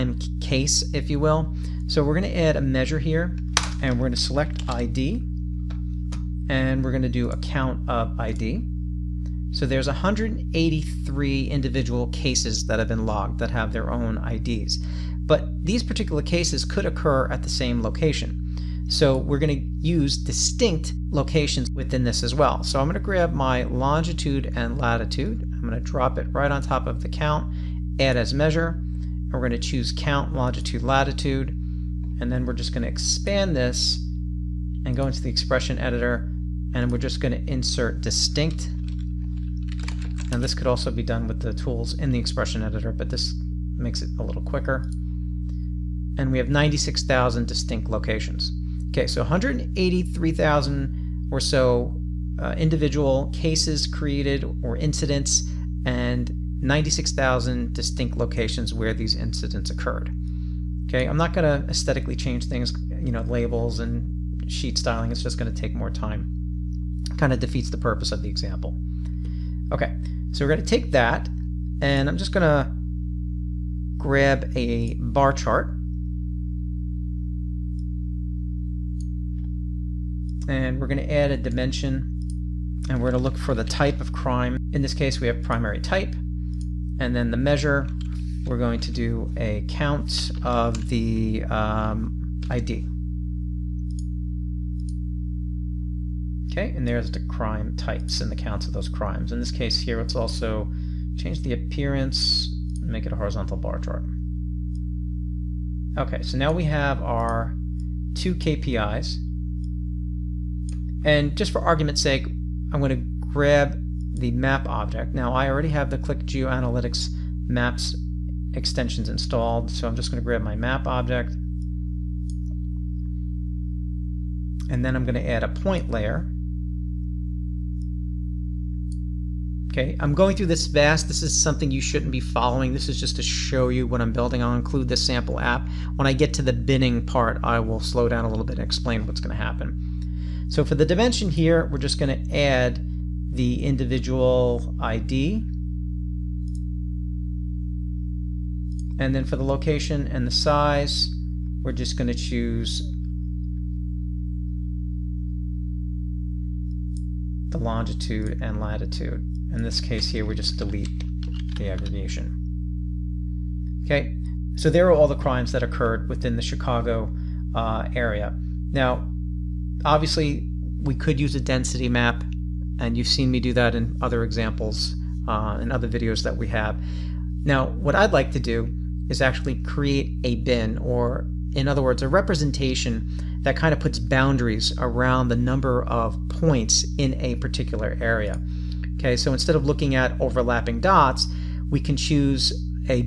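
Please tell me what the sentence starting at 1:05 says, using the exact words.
It's just going to take more time.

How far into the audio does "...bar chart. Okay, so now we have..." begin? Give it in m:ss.
1:43.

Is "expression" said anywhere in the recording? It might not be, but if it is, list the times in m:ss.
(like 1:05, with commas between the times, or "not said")
0:35, 0:42.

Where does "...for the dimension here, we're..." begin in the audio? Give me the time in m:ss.
2:20.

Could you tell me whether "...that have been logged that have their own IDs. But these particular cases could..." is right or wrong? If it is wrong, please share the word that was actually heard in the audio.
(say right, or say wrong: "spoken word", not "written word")
right.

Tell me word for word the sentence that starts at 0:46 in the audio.
And we have 96,000 distinct locations.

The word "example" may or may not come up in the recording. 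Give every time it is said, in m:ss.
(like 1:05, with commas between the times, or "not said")
1:08, 2:54.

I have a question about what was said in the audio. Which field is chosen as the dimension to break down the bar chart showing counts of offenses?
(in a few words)
primary type.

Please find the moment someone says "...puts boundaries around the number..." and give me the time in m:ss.
3:03.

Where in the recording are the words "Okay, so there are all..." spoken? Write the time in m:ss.
2:43.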